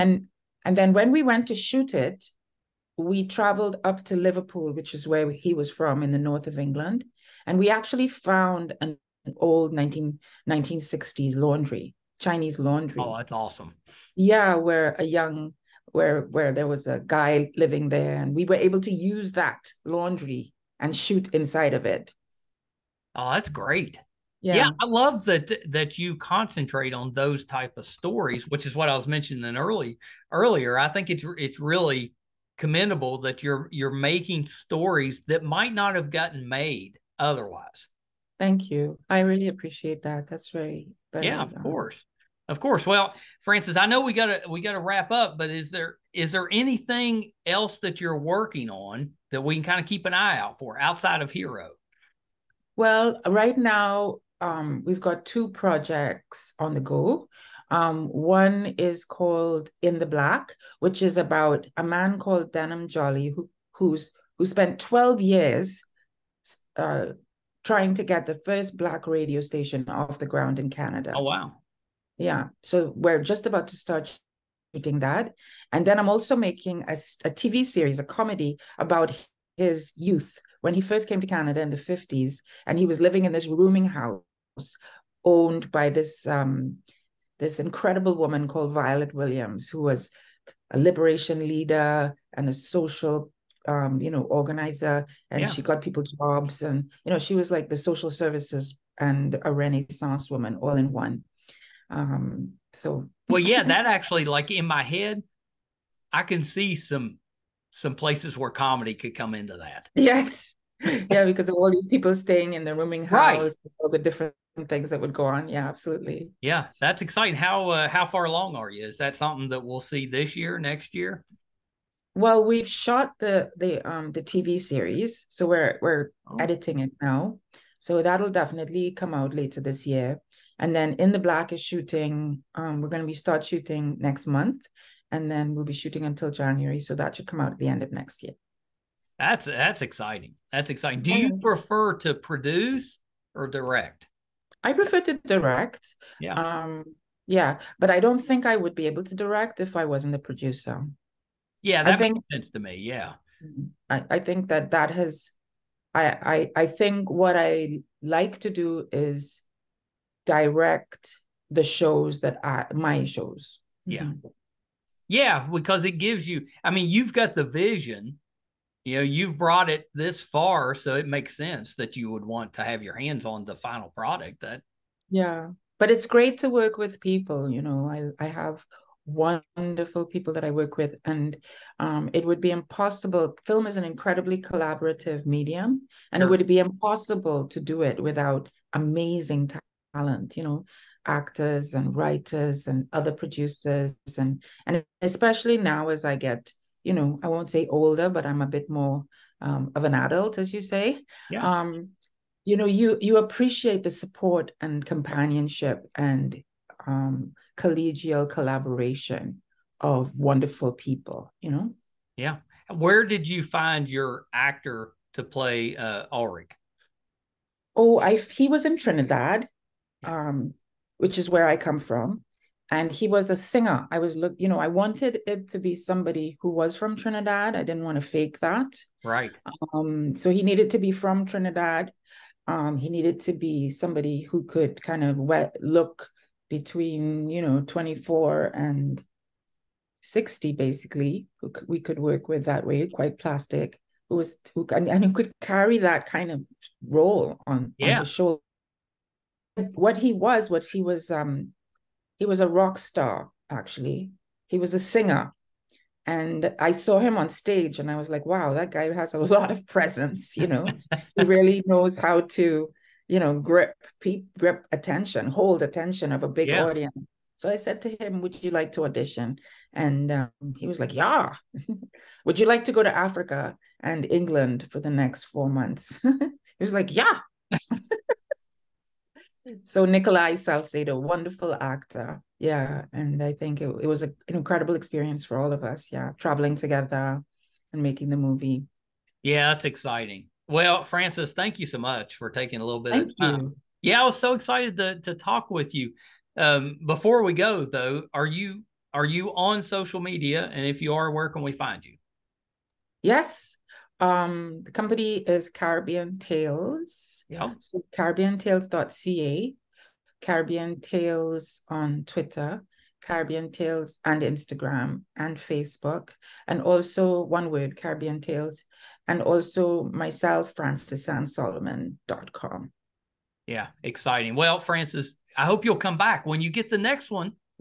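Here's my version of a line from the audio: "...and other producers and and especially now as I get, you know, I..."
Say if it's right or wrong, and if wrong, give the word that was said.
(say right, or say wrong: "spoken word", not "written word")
right.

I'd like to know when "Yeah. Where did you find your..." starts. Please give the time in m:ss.
3:32.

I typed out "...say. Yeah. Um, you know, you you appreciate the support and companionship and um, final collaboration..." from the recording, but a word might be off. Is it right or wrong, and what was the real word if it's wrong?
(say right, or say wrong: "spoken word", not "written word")
wrong: "collegial", not "final".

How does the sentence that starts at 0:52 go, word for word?
Well, right now, um, we've got two projects on the go.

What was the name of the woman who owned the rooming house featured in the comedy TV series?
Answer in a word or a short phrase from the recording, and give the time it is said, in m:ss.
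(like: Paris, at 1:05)
Violet Williams, at 1:28.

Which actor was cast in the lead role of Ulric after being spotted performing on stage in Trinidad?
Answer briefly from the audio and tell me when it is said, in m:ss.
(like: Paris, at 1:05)
Nikolai Salcedo, at 4:39.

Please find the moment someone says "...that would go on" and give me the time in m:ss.
1:54.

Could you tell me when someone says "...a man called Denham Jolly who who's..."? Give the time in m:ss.
1:01.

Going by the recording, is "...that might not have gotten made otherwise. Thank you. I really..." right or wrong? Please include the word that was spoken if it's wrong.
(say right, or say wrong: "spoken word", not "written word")
right.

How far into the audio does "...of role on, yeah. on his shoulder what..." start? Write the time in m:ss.
4:06.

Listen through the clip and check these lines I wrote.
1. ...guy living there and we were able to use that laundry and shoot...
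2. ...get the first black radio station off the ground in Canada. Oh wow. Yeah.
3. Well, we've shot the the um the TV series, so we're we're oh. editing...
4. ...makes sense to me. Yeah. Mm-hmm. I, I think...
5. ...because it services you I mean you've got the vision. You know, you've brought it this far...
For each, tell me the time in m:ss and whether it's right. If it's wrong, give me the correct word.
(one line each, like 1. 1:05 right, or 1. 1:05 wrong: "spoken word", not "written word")
1. 0:17 right
2. 1:08 right
3. 2:02 right
4. 2:32 right
5. 2:45 wrong: "gives", not "services".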